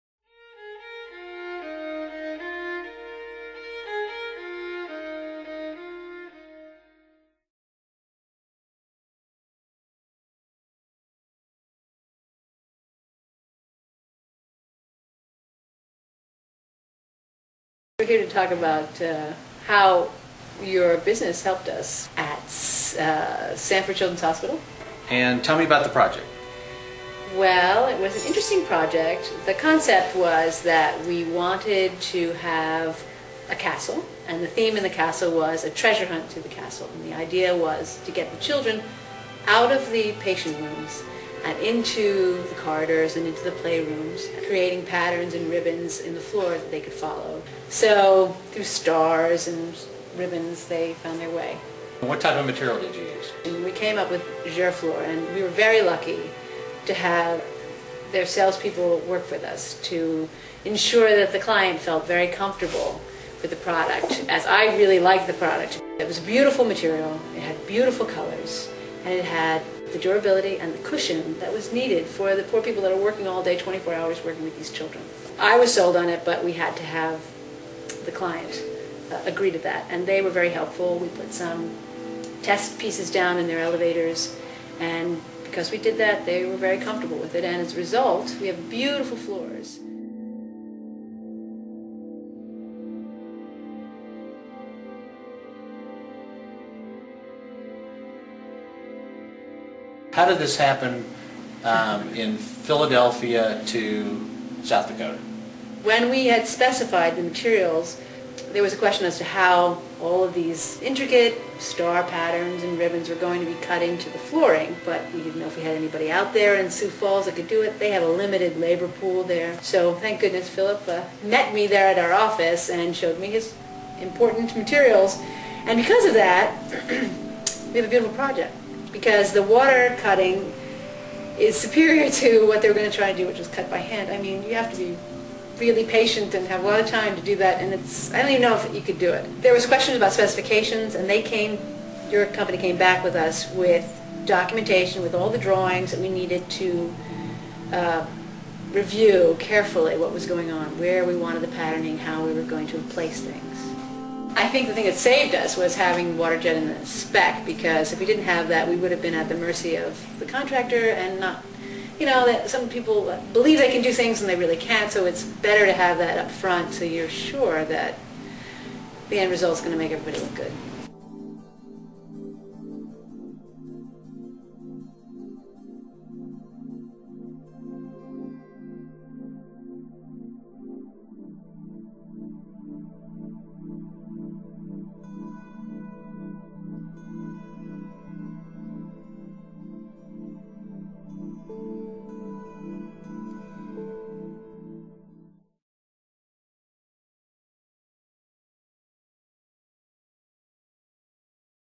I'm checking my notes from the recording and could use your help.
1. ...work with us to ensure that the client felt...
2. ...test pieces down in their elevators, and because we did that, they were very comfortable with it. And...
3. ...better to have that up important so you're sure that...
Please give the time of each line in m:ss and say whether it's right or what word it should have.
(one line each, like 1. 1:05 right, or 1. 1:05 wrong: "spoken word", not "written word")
1. 0:59 right
2. 1:22 right
3. 2:45 wrong: "front", not "important".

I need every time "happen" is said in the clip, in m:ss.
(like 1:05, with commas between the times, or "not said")
1:40.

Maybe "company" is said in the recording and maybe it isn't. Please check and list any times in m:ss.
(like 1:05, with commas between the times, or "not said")
2:22.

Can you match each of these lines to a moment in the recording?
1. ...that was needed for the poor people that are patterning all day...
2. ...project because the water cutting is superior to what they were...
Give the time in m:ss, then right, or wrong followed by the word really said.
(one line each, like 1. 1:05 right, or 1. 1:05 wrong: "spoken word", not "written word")
1. 1:11 wrong: "working", not "patterning"
2. 2:08 right.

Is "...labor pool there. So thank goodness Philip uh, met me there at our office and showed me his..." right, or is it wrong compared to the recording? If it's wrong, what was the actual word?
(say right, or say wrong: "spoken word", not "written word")
right.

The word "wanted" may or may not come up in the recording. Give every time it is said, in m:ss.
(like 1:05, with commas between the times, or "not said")
0:31, 2:31.